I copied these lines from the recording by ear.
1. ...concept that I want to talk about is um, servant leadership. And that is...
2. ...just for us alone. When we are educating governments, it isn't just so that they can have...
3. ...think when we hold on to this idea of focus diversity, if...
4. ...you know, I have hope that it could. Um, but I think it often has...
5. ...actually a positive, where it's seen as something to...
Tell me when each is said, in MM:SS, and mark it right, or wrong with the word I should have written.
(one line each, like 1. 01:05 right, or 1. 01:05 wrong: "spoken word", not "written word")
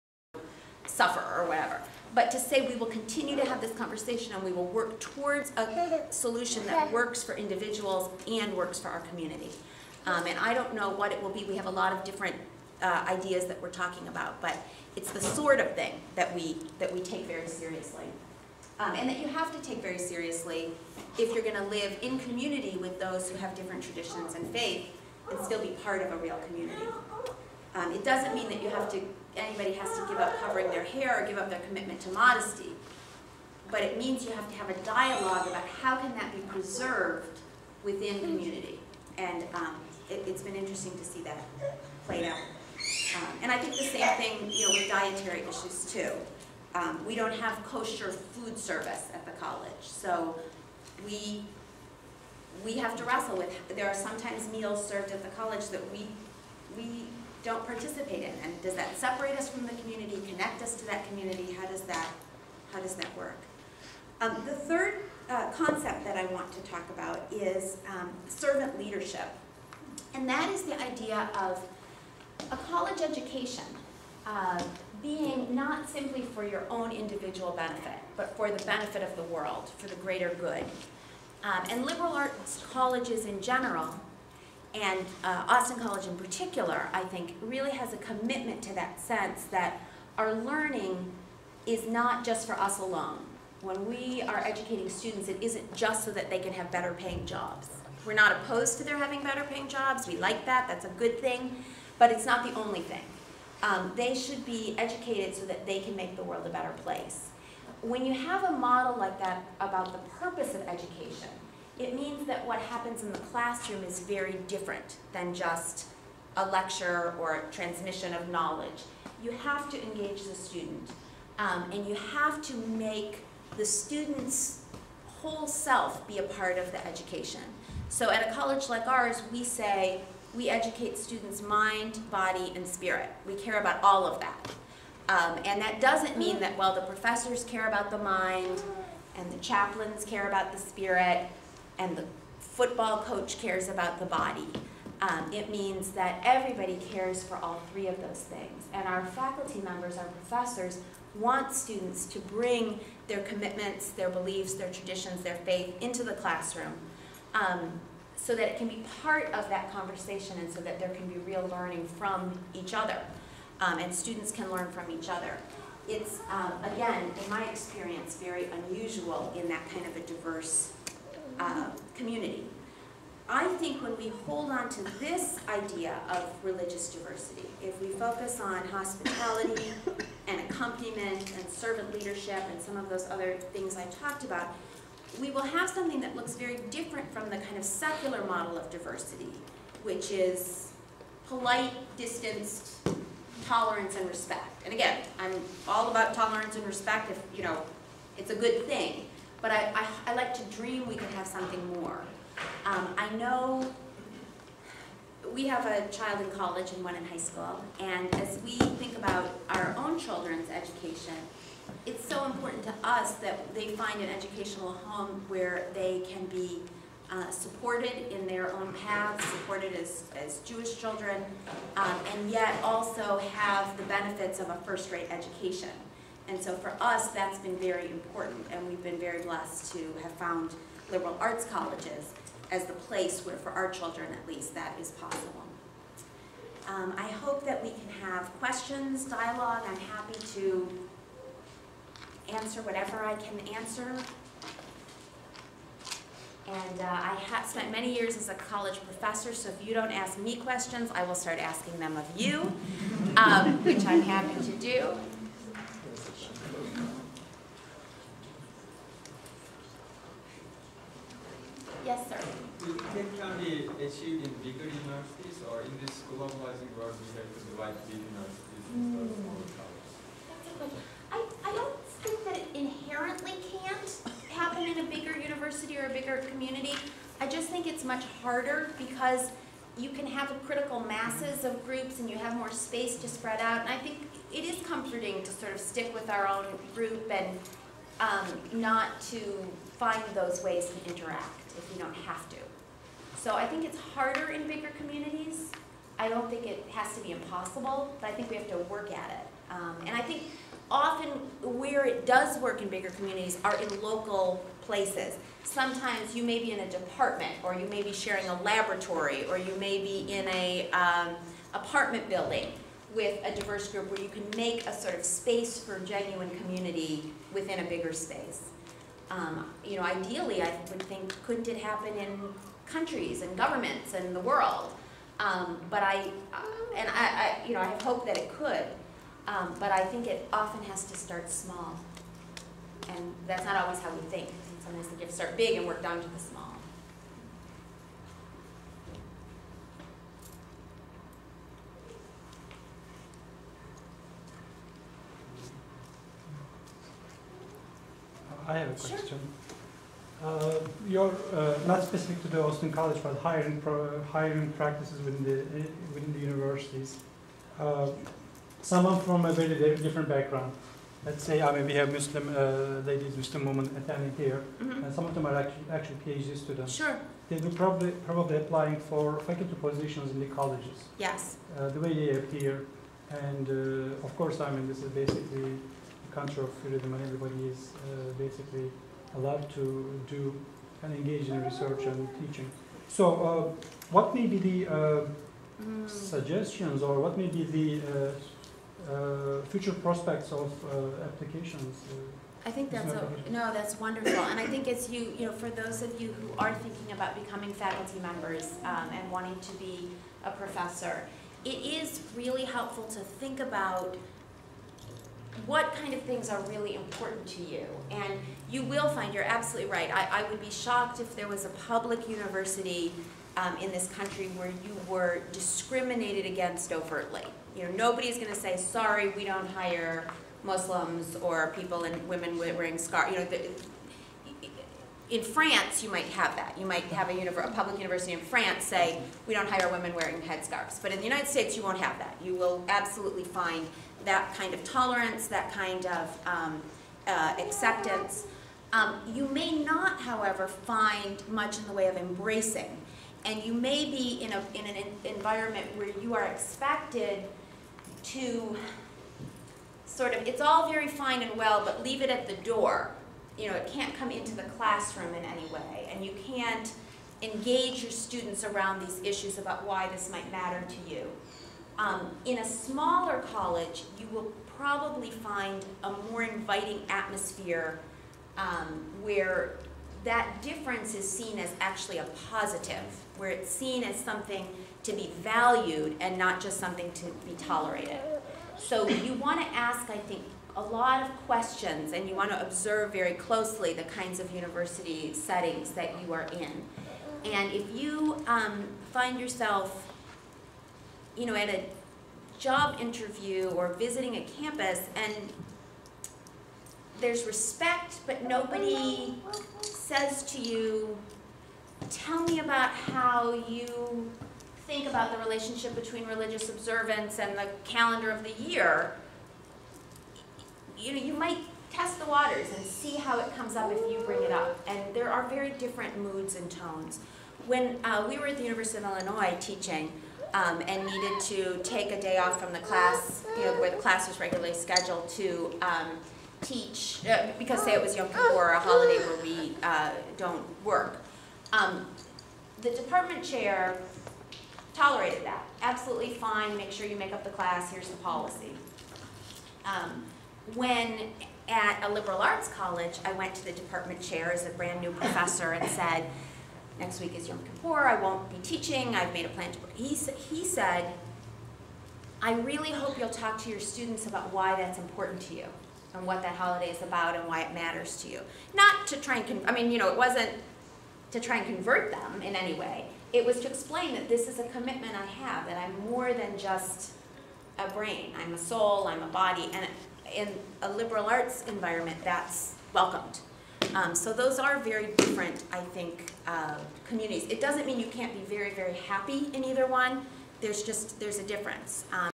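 1. 01:05 right
2. 01:32 wrong: "students", not "governments"
3. 02:53 wrong: "religious", not "focus"
4. 05:27 right
5. 07:51 right.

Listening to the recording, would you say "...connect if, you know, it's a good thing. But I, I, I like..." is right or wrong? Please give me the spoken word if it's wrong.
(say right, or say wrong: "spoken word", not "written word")
wrong: "respect", not "connect".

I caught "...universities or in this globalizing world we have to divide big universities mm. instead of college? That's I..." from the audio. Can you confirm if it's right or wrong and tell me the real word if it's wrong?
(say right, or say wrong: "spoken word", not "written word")
right.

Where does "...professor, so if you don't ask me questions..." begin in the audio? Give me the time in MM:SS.
04:08.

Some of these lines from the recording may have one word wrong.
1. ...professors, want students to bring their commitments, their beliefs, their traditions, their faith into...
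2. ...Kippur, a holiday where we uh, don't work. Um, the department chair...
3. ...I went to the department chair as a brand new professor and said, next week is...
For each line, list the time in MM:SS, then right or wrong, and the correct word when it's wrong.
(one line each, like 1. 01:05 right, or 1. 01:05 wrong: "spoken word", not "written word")
1. 02:30 right
2. 08:48 right
3. 09:03 right.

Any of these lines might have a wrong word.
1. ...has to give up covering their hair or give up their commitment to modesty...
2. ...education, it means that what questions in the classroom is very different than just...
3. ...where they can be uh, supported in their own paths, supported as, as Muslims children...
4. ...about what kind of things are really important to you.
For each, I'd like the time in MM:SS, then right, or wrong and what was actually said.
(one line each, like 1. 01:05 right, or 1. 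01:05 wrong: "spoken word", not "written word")
1. 00:29 right
2. 01:50 wrong: "happens", not "questions"
3. 03:35 wrong: "Jewish", not "Muslims"
4. 06:43 right.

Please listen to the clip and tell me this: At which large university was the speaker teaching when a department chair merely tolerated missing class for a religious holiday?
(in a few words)
University of Illinois.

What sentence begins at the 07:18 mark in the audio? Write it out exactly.
Um, you may not, however, find much in the way of embracing.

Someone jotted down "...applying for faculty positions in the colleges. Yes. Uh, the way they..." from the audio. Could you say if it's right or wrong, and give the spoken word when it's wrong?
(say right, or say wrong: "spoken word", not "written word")
right.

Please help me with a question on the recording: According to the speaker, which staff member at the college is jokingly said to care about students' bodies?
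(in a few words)
the football coach.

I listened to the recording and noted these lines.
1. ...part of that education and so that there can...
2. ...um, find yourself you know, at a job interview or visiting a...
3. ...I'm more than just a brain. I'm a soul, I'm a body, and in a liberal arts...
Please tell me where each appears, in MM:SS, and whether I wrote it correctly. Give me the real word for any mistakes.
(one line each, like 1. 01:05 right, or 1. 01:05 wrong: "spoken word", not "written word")
1. 02:39 wrong: "conversation", not "education"
2. 08:08 right
3. 09:25 right.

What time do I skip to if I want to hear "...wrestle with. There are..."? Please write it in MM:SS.
00:53.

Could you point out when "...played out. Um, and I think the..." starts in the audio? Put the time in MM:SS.
00:42.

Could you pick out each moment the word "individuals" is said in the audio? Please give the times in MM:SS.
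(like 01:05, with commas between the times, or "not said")
00:07, 01:16.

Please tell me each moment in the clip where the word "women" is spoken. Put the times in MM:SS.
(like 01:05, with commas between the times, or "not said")
06:03, 07:02, 07:09.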